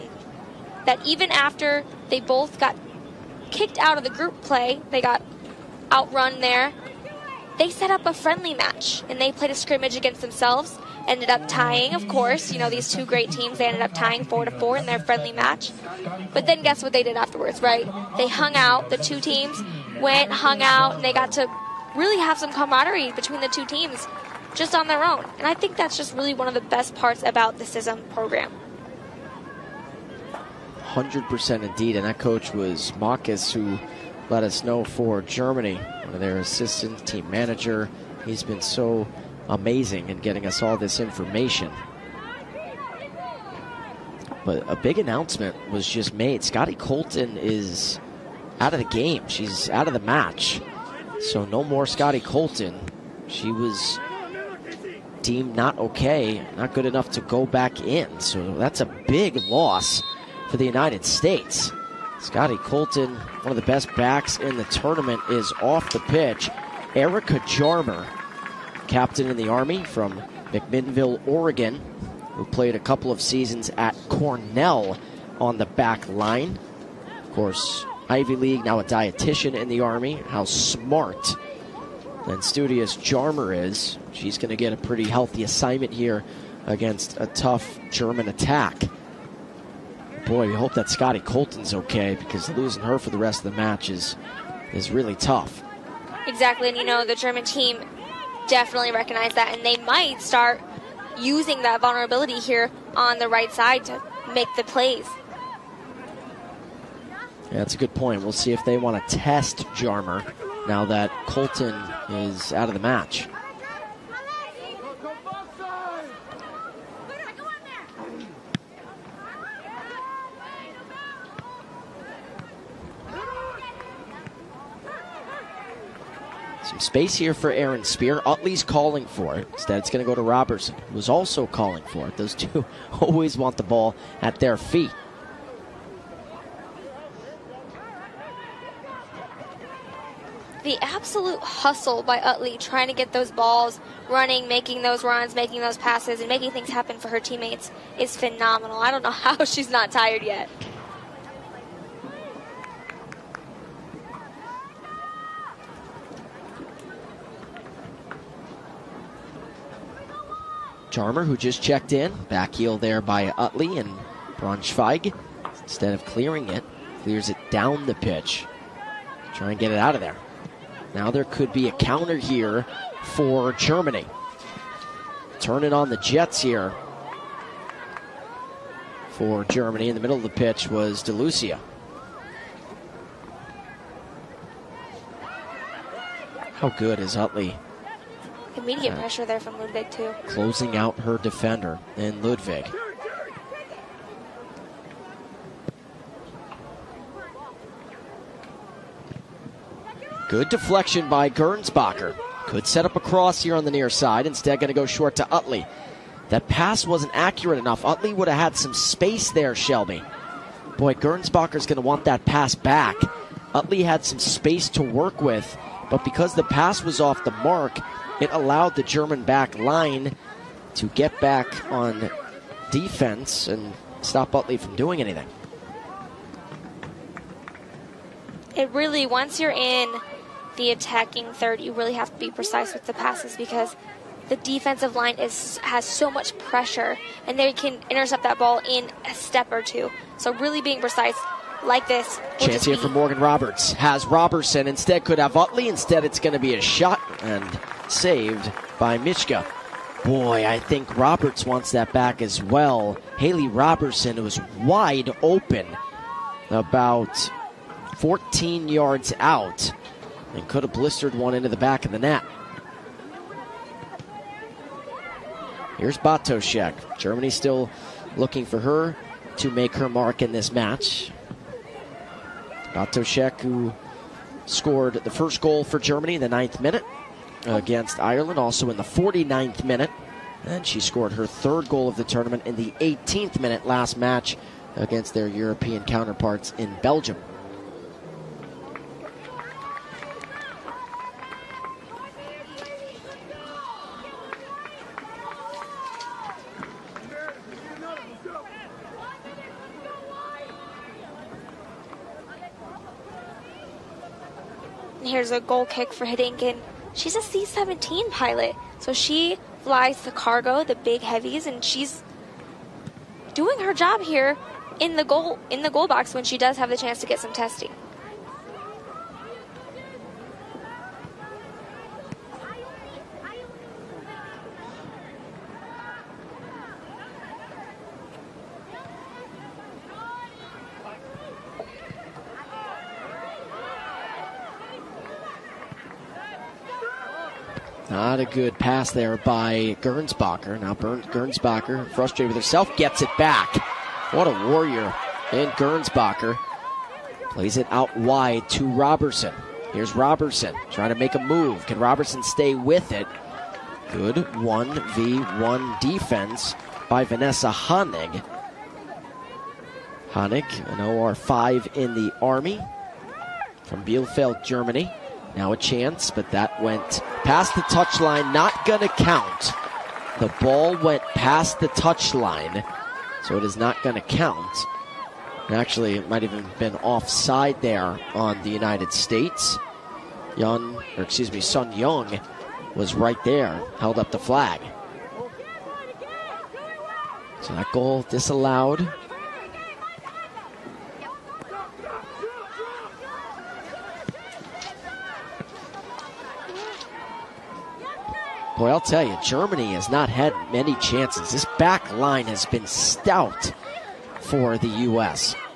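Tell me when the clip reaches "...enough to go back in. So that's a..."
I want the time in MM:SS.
00:56.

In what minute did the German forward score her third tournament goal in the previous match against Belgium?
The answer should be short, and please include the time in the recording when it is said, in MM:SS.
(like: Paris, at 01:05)
18th minute, at 04:42.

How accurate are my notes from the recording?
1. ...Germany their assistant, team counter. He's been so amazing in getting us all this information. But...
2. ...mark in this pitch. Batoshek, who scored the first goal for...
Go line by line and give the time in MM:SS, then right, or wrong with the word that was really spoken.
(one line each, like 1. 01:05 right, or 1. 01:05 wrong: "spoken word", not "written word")
1. 00:35 wrong: "manager", not "counter"
2. 04:29 wrong: "match", not "pitch".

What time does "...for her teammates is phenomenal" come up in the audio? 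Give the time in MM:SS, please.
02:26.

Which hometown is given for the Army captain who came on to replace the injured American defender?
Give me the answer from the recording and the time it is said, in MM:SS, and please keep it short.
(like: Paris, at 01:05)
McMinnville, Oregon, at 01:10.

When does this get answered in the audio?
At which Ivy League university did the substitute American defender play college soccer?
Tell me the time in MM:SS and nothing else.
01:14.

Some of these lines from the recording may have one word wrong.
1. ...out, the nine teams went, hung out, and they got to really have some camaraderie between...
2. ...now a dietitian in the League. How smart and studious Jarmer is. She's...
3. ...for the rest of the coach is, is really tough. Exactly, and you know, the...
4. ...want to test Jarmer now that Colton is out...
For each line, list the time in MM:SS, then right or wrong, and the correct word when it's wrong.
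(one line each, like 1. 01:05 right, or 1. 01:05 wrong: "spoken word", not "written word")
1. 00:18 wrong: "two", not "nine"
2. 01:18 wrong: "Army", not "League"
3. 01:32 wrong: "match", not "coach"
4. 01:48 right.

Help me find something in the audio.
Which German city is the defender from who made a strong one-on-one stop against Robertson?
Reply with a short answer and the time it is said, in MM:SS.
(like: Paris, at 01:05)
Bielefeld, at 06:03.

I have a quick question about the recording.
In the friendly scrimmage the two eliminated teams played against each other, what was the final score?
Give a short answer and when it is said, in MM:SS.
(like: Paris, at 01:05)
4 to 4, at 00:14.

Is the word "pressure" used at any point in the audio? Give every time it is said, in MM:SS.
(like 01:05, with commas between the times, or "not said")
03:08, 03:56.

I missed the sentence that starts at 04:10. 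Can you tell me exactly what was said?
Boy, I think Roberts wants that back as well.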